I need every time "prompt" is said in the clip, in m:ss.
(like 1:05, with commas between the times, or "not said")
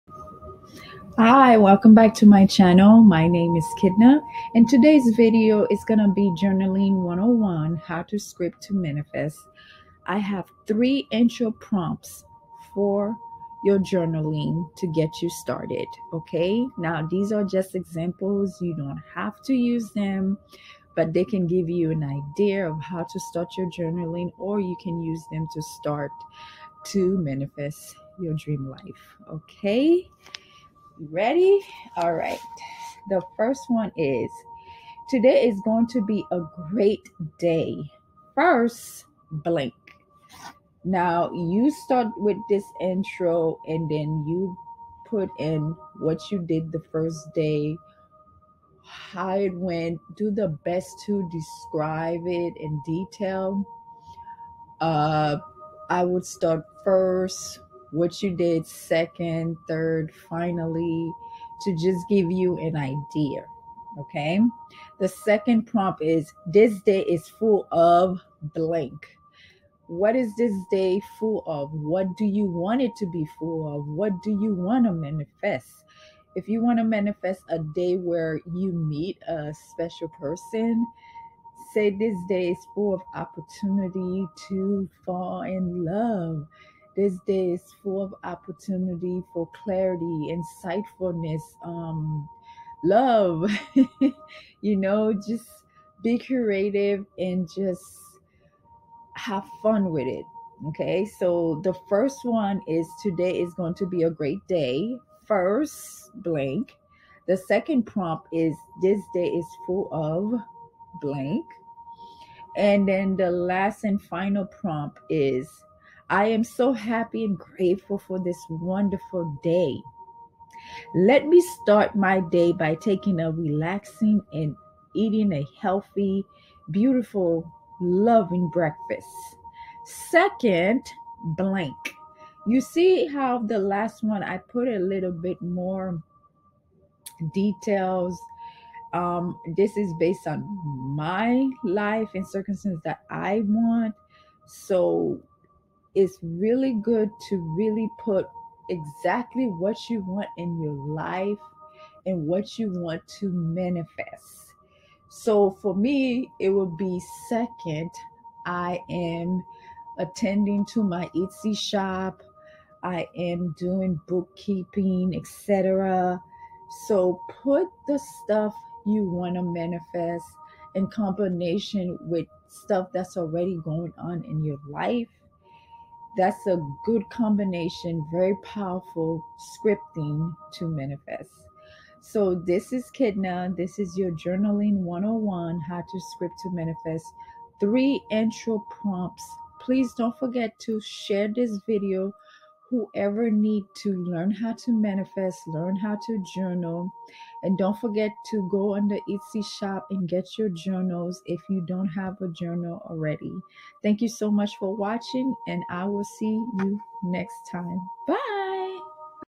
0:11, 1:05, 1:47, 1:54, 3:08.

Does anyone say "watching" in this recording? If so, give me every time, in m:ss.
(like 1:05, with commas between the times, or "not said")
3:24.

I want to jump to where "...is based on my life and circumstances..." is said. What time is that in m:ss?
2:19.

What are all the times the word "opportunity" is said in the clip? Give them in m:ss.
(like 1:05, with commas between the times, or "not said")
1:23, 1:28.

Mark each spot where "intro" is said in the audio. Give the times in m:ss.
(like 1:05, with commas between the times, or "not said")
0:11, 0:42, 3:08.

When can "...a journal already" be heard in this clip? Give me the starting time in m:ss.
3:22.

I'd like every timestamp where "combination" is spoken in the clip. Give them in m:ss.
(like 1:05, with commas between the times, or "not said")
2:50, 2:57.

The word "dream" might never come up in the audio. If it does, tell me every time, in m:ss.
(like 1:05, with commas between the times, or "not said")
0:28.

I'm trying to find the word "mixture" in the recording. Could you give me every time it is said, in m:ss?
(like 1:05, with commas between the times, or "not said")
not said.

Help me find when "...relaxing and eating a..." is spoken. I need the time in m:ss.
2:03.